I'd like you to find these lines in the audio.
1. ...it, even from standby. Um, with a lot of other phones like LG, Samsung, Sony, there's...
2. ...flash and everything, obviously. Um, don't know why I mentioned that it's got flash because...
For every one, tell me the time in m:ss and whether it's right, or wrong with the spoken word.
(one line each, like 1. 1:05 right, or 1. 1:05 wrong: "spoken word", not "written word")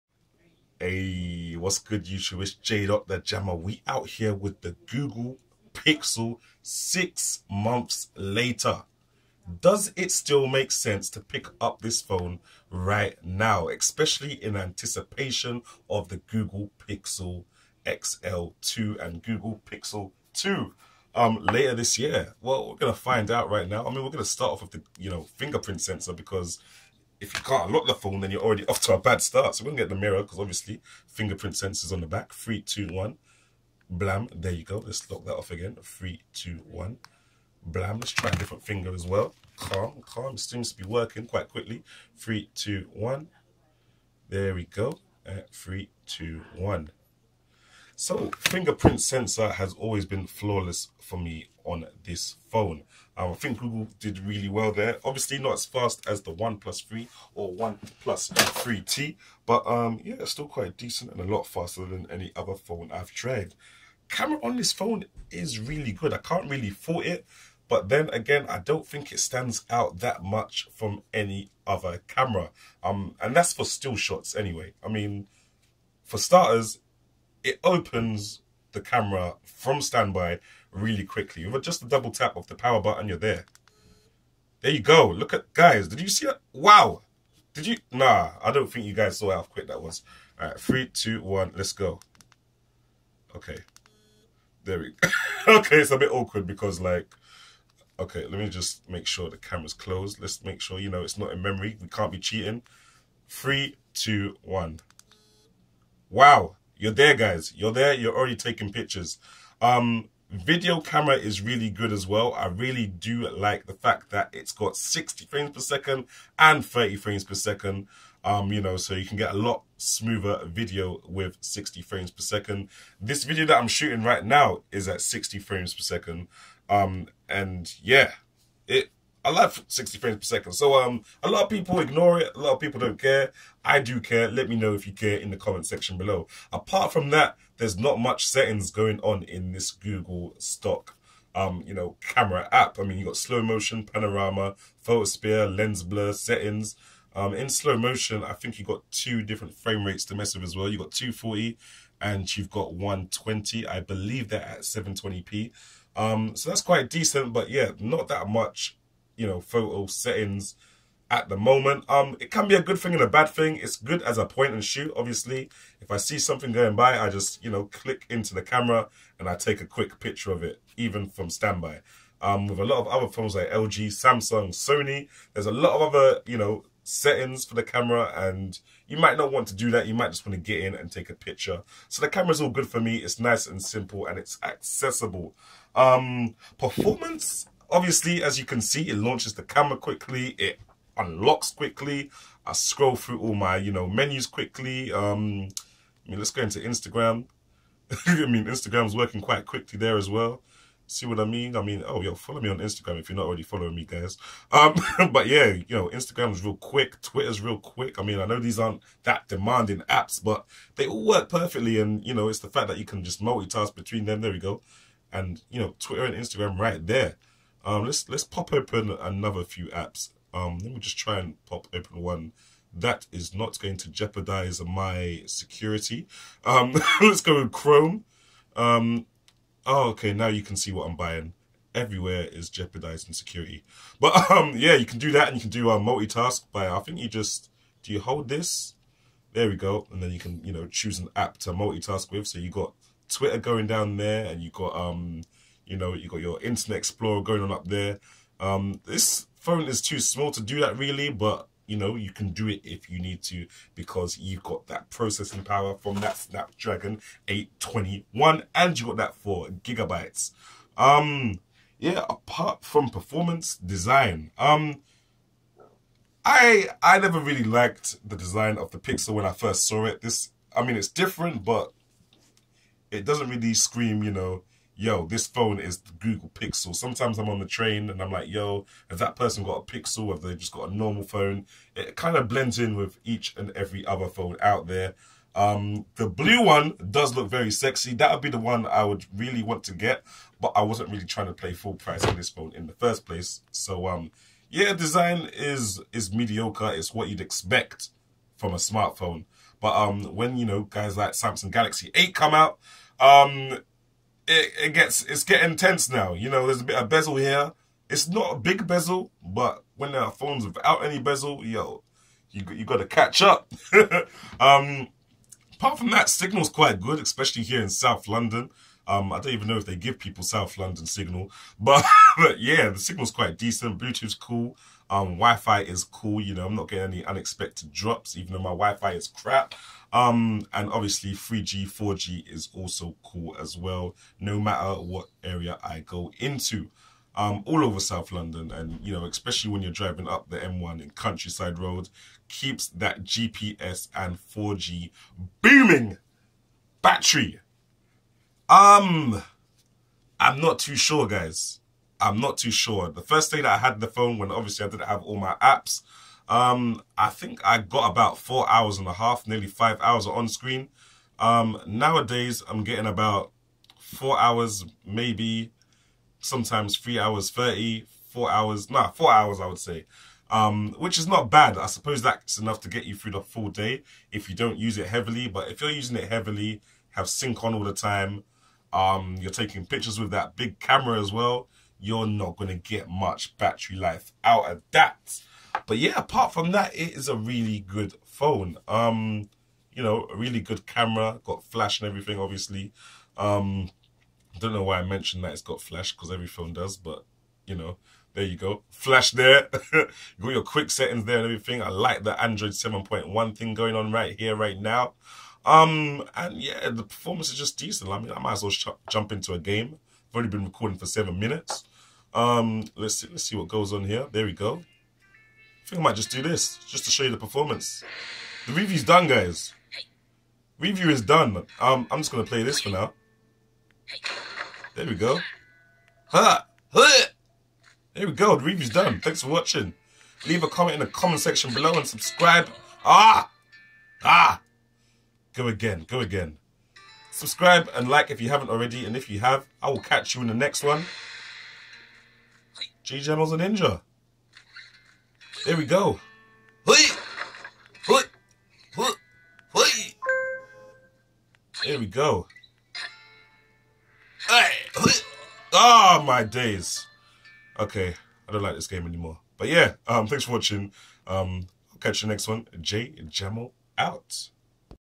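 1. 2:50 right
2. 6:31 right.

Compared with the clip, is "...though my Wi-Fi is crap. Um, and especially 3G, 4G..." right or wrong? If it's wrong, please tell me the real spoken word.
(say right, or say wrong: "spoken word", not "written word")
wrong: "obviously", not "especially".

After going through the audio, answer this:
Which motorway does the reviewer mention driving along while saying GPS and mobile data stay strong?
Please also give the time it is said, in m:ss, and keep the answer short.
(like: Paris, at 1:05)
M1, at 5:40.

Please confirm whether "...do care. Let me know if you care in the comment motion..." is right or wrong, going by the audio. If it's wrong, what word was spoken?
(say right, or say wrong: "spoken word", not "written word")
wrong: "section", not "motion".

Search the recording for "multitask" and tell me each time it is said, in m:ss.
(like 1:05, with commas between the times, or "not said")
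3:33, 3:55, 4:01.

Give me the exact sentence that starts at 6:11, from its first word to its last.
I suppose that's enough to get you through the full day if you don't use it heavily.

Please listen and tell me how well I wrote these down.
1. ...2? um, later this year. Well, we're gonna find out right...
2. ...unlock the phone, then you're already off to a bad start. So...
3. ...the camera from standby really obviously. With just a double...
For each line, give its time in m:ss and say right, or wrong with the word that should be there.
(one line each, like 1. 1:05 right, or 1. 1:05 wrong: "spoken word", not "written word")
1. 0:20 right
2. 0:27 right
3. 1:18 wrong: "quickly", not "obviously".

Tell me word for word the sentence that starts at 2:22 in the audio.
I mean, you got slow motion, panorama, photosphere, lens blur, settings.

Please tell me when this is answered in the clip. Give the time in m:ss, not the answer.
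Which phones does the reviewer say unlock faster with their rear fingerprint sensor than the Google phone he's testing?
0:56.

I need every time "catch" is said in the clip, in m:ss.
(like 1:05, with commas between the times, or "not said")
5:12, 7:19, 7:41.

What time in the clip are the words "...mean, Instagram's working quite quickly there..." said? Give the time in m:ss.
3:18.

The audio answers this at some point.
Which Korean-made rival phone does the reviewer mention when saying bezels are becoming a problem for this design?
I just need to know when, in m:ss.
5:01.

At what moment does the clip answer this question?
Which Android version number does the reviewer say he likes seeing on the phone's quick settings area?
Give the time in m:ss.
6:42.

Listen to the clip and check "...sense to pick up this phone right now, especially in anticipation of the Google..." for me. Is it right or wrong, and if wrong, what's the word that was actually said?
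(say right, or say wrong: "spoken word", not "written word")
right.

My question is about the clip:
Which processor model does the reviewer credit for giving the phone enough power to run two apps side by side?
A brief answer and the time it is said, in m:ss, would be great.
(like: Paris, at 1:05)
Snapdragon 821, at 4:16.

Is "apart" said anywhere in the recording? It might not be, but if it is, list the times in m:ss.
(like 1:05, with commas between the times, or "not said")
2:16, 4:22, 5:15, 6:25.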